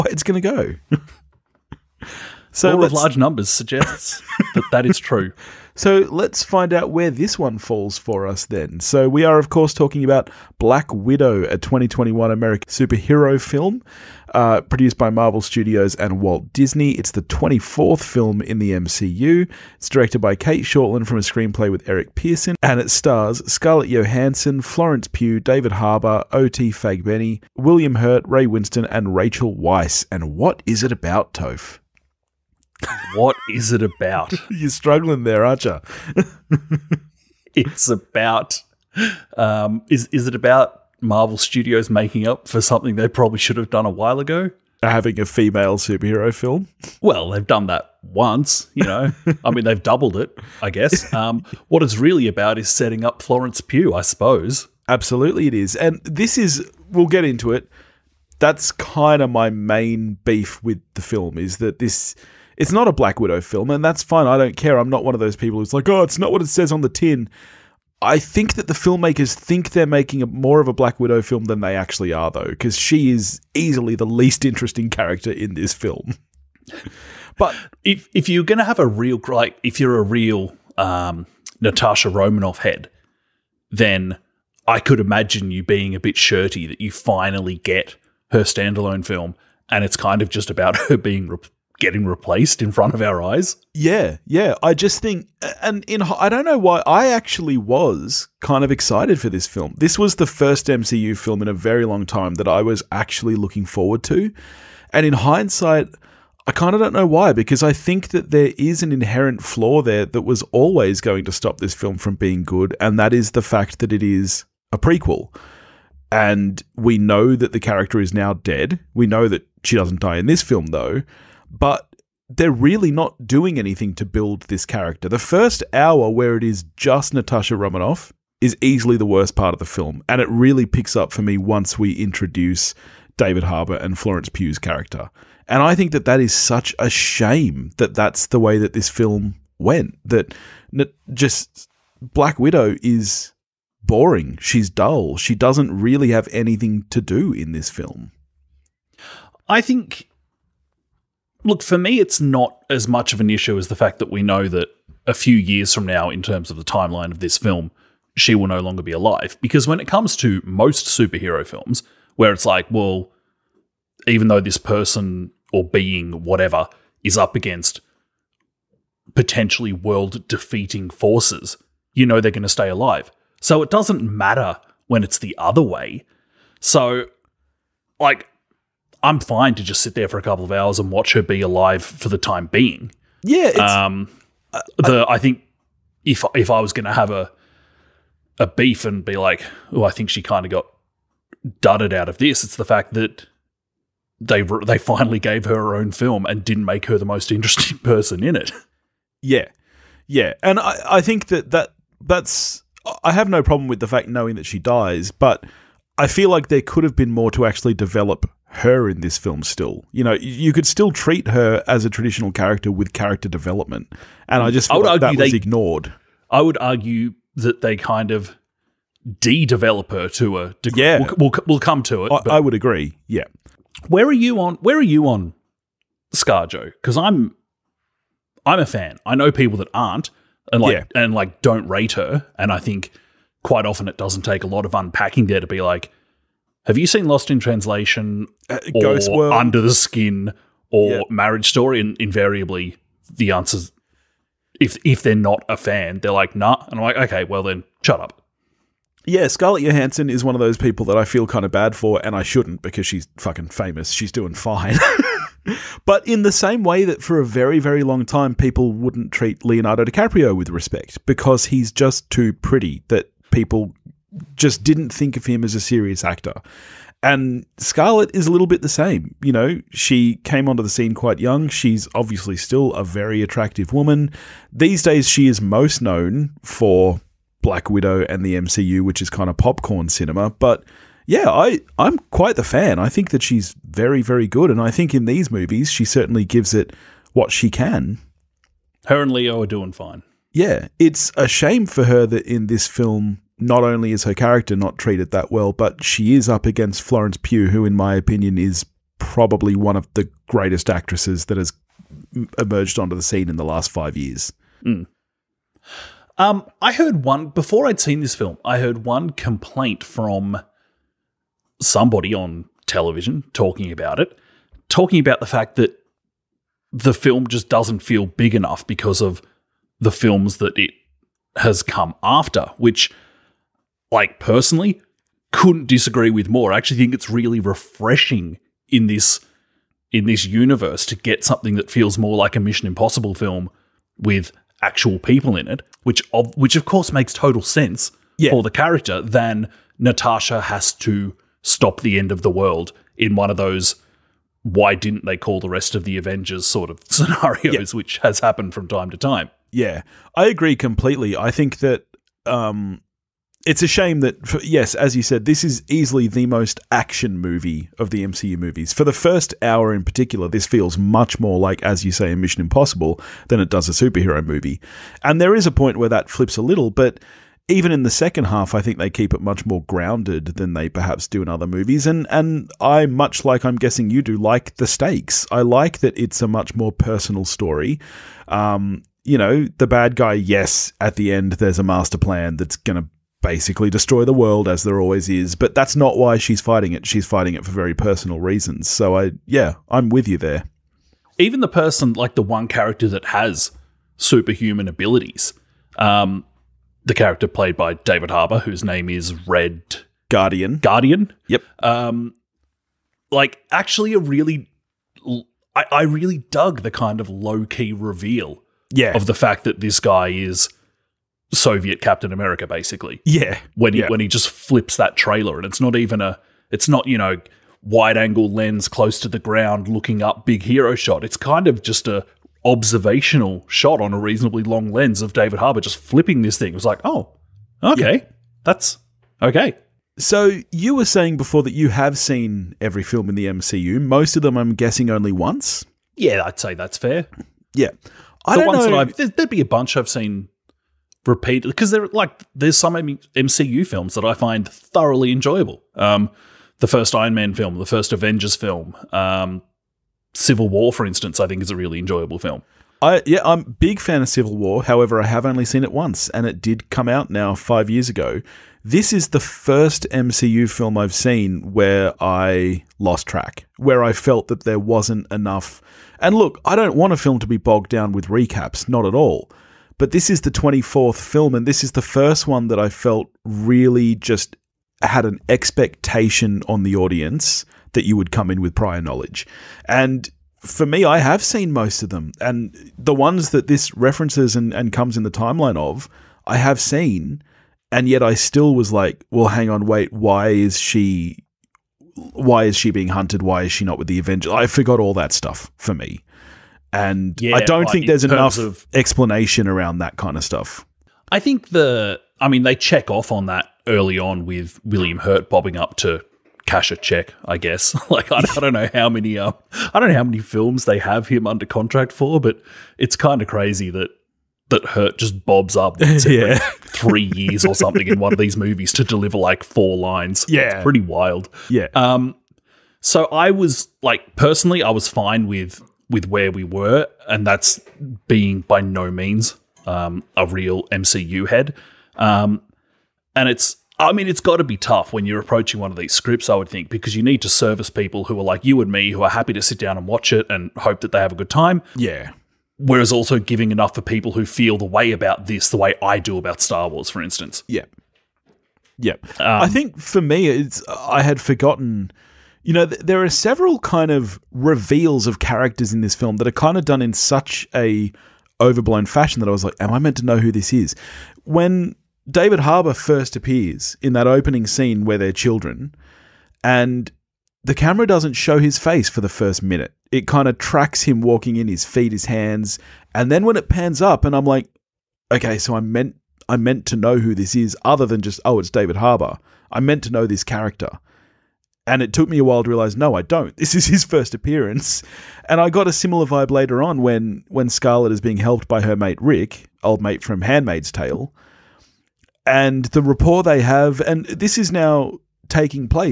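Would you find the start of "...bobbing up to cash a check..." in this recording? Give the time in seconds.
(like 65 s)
505 s.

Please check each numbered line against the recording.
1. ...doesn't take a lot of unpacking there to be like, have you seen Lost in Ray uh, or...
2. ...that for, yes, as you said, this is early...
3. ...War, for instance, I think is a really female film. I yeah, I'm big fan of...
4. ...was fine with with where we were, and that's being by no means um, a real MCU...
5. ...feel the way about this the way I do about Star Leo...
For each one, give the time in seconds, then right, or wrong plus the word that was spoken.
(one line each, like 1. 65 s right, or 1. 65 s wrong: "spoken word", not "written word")
1. 233 s wrong: "Translation", not "Ray"
2. 353 s wrong: "easily", not "early"
3. 450 s wrong: "enjoyable", not "female"
4. 524 s right
5. 544 s wrong: "Wars", not "Leo".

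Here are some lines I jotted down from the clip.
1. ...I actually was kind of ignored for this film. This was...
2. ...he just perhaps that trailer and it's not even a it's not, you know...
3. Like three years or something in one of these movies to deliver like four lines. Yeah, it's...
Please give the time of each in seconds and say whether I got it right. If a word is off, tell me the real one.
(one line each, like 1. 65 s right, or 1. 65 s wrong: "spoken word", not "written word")
1. 96 s wrong: "excited", not "ignored"
2. 413 s wrong: "flips", not "perhaps"
3. 516 s right.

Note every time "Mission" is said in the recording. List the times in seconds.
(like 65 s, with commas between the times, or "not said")
332 s, 362 s.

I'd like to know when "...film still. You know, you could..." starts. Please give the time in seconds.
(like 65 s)
209 s.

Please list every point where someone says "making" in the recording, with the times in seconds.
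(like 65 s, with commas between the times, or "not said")
41 s, 69 s.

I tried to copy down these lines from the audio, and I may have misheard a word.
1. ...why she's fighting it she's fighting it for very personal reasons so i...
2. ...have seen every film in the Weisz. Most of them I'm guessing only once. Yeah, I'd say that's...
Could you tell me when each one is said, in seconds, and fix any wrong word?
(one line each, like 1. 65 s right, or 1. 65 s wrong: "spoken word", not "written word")
1. 385 s right
2. 431 s wrong: "MCU", not "Weisz".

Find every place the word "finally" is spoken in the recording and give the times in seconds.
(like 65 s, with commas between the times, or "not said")
86 s, 194 s.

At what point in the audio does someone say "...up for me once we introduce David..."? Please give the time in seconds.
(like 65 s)
130 s.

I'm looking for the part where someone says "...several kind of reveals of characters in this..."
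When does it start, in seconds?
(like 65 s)
553 s.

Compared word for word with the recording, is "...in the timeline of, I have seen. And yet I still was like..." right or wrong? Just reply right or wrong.
right.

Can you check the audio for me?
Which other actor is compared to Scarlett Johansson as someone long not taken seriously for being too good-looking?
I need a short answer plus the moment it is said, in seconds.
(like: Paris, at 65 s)
Leonardo DiCaprio, at 259 s.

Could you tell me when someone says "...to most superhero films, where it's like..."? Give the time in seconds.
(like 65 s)
160 s.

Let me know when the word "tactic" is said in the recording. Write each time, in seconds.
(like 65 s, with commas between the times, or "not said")
not said.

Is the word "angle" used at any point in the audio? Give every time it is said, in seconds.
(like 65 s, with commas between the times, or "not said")
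417 s.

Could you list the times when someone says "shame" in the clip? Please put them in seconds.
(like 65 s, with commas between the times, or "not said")
136 s, 291 s, 353 s.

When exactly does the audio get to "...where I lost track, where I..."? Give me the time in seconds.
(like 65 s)
461 s.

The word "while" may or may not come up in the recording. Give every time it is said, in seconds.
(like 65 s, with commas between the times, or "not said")
43 s, 582 s.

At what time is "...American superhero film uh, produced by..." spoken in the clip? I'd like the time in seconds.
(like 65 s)
12 s.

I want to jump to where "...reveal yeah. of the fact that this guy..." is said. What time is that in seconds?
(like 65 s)
407 s.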